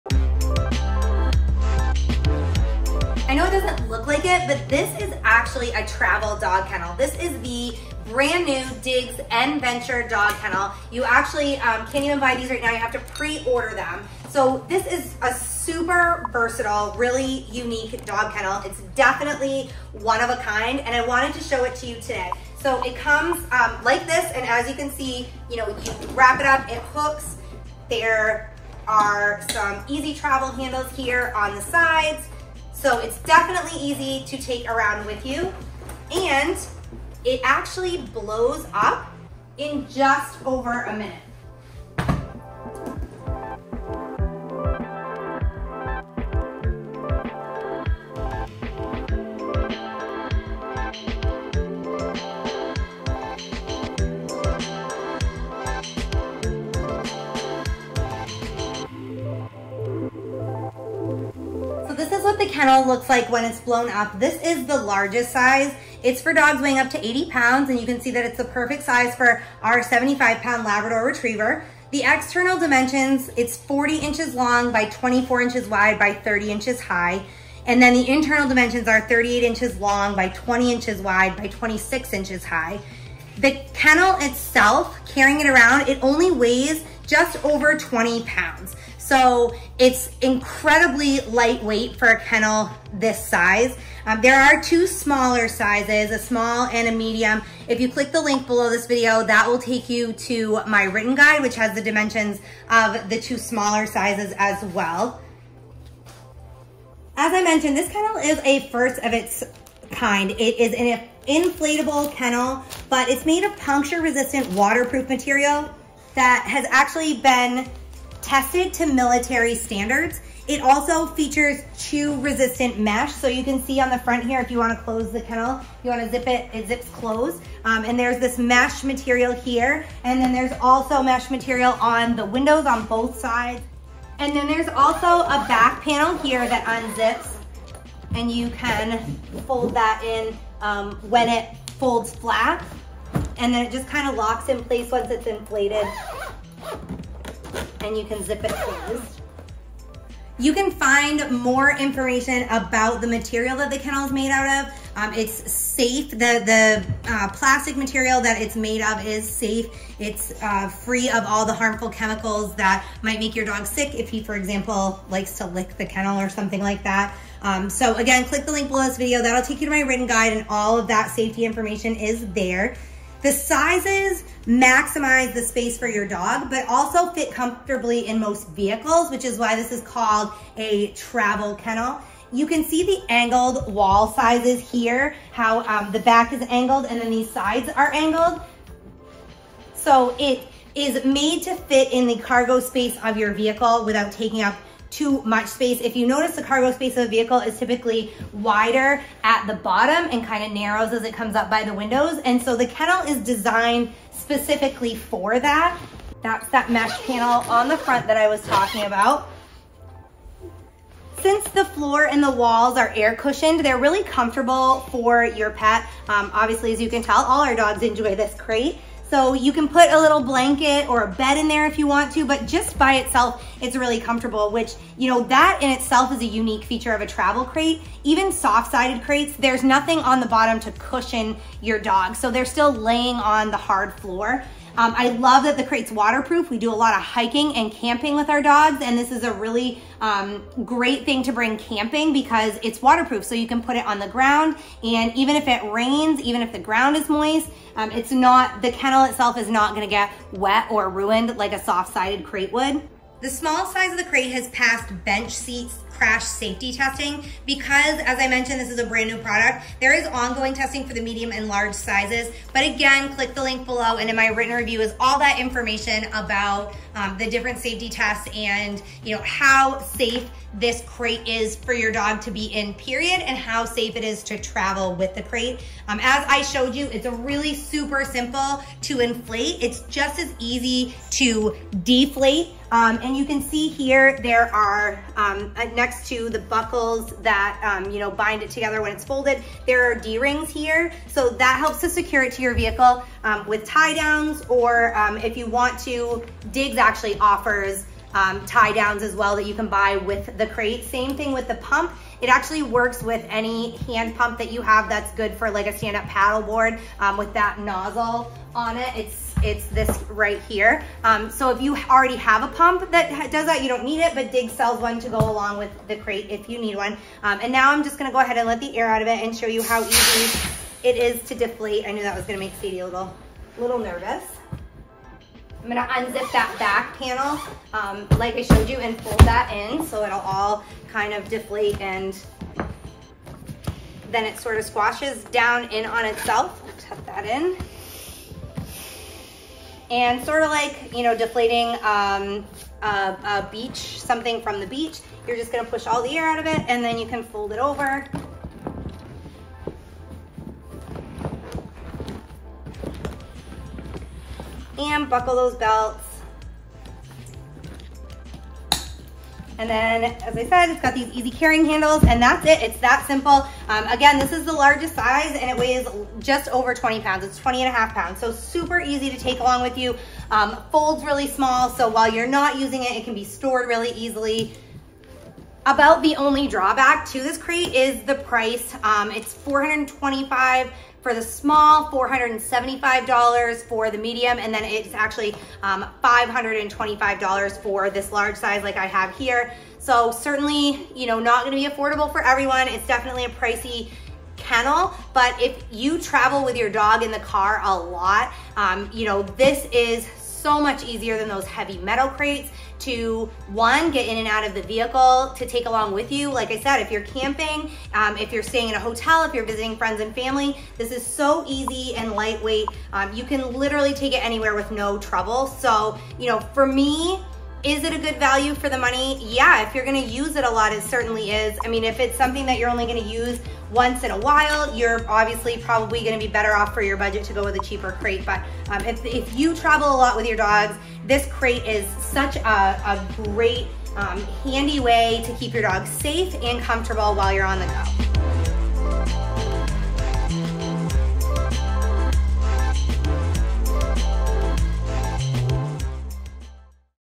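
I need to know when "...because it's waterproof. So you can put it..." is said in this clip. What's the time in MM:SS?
04:02.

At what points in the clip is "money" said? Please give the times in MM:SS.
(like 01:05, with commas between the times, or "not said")
06:58.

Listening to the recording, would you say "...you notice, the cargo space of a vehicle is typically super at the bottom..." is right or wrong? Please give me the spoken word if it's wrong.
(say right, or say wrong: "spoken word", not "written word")
wrong: "wider", not "super".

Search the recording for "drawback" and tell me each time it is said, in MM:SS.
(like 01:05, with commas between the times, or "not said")
06:16.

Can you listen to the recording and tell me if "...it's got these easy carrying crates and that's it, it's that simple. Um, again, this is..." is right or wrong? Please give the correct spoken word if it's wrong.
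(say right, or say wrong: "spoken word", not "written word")
wrong: "handles", not "crates".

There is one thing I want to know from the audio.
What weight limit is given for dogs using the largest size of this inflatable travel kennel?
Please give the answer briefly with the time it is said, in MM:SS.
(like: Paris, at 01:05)
80 pounds, at 01:07.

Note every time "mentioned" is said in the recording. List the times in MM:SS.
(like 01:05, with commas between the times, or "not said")
01:47, 04:18.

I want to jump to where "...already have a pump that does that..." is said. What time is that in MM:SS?
05:11.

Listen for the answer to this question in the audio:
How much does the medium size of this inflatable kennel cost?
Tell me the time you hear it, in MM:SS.
06:21.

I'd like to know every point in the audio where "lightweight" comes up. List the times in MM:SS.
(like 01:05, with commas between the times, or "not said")
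01:31, 06:52.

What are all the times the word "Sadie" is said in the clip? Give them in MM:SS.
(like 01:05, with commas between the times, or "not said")
05:22.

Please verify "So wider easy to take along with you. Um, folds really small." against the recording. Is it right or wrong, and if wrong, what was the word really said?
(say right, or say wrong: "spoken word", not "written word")
wrong: "super", not "wider".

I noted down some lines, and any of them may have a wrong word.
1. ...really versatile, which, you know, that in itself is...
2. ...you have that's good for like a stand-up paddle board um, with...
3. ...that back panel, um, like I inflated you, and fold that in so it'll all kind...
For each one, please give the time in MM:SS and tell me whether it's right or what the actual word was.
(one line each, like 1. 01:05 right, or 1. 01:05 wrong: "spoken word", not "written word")
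1. 03:43 wrong: "comfortable", not "versatile"
2. 05:04 right
3. 05:26 wrong: "showed", not "inflated".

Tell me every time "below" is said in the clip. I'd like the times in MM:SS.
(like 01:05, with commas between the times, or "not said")
01:38, 02:48, 04:23.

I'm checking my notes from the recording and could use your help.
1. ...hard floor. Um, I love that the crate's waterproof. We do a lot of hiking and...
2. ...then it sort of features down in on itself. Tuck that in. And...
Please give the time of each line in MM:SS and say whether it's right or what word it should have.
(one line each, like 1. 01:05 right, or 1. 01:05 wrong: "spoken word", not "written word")
1. 03:53 right
2. 05:34 wrong: "squashes", not "features".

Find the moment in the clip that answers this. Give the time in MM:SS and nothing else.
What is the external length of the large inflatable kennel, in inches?
01:13.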